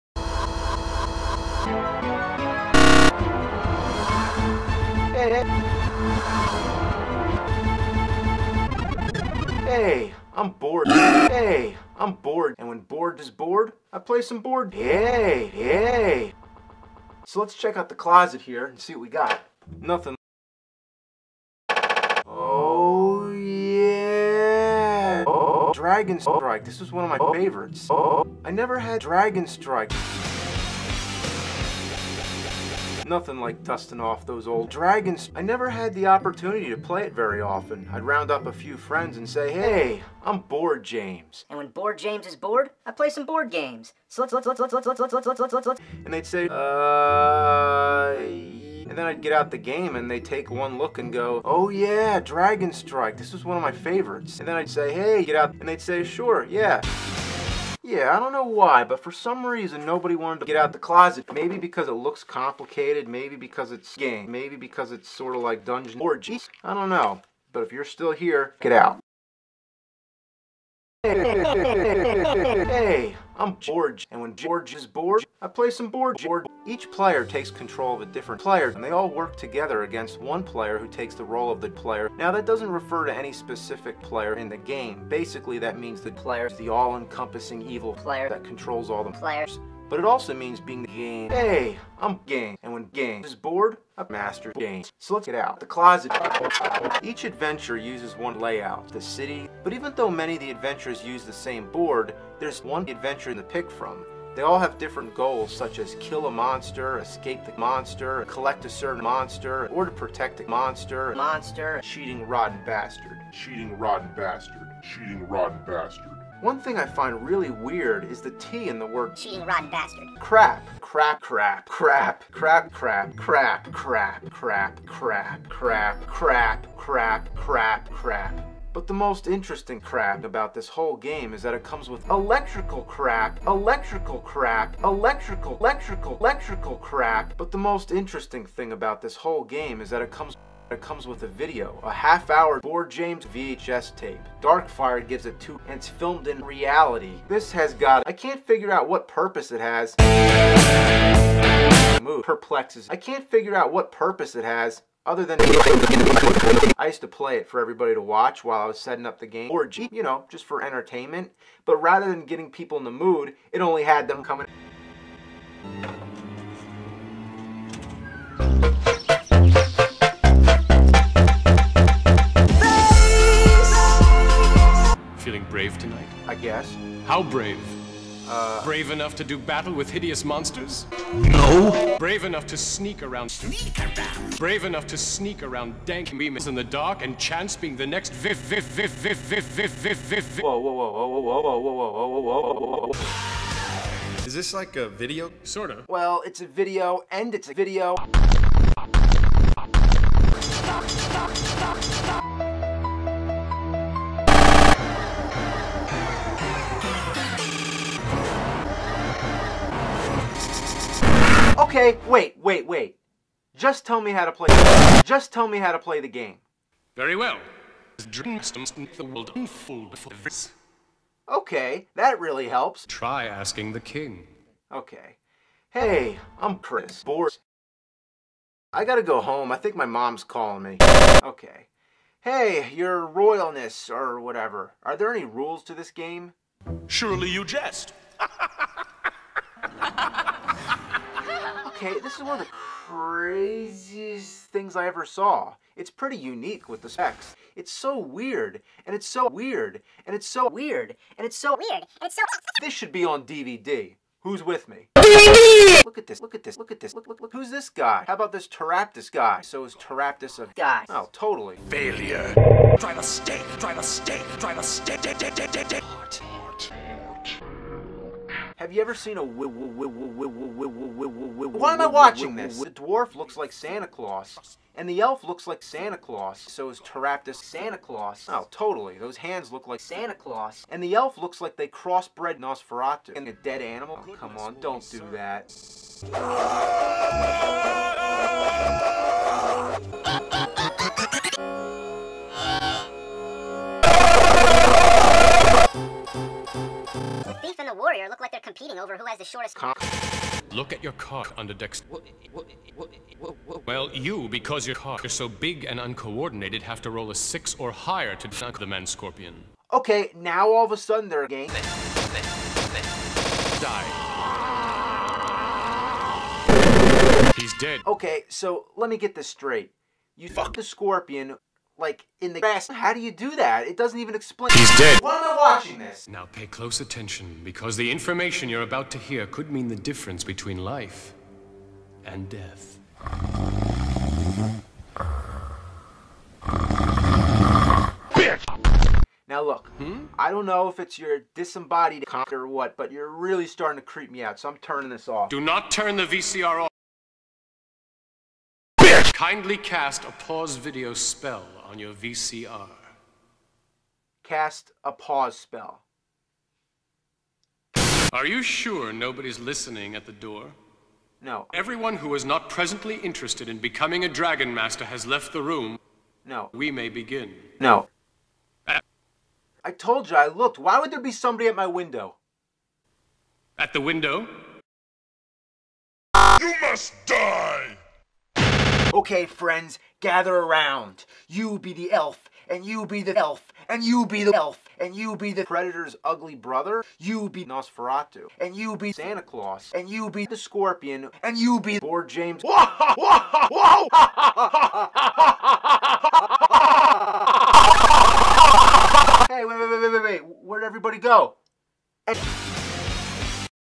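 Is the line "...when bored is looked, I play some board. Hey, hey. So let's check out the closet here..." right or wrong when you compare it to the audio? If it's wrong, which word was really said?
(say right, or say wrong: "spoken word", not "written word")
wrong: "bored", not "looked".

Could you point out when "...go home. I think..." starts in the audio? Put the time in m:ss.
3:49.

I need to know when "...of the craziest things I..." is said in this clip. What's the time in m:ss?
4:02.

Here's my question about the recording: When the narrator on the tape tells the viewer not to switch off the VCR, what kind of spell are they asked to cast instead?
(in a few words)
pause video spell.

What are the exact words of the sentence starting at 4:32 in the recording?
The dwarf looks like Santa Claus, and the elf looks like Santa Claus.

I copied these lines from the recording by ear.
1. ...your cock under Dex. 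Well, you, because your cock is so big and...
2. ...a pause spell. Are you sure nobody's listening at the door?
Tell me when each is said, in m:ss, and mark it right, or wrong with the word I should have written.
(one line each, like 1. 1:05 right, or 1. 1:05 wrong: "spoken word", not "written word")
1. 5:00 right
2. 5:54 right.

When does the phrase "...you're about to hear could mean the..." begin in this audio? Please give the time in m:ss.
5:28.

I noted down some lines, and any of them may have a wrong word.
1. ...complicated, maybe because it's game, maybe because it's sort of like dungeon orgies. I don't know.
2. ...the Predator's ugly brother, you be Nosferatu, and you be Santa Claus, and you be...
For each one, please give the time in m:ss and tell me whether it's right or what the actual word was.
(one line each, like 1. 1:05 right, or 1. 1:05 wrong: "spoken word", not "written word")
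1. 1:02 right
2. 6:25 right.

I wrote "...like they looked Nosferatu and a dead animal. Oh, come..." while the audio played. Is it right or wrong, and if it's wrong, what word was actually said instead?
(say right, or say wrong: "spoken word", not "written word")
wrong: "crossbred", not "looked".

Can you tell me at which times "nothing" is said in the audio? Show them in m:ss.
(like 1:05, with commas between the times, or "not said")
0:19, 0:33.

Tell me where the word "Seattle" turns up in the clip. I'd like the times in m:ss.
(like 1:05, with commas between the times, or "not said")
not said.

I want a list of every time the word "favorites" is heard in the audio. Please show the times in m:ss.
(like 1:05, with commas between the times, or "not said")
0:27, 0:53.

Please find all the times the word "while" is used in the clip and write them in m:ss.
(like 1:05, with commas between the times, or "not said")
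2:38.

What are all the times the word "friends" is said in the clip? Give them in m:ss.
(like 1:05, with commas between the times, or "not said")
0:38, 6:19.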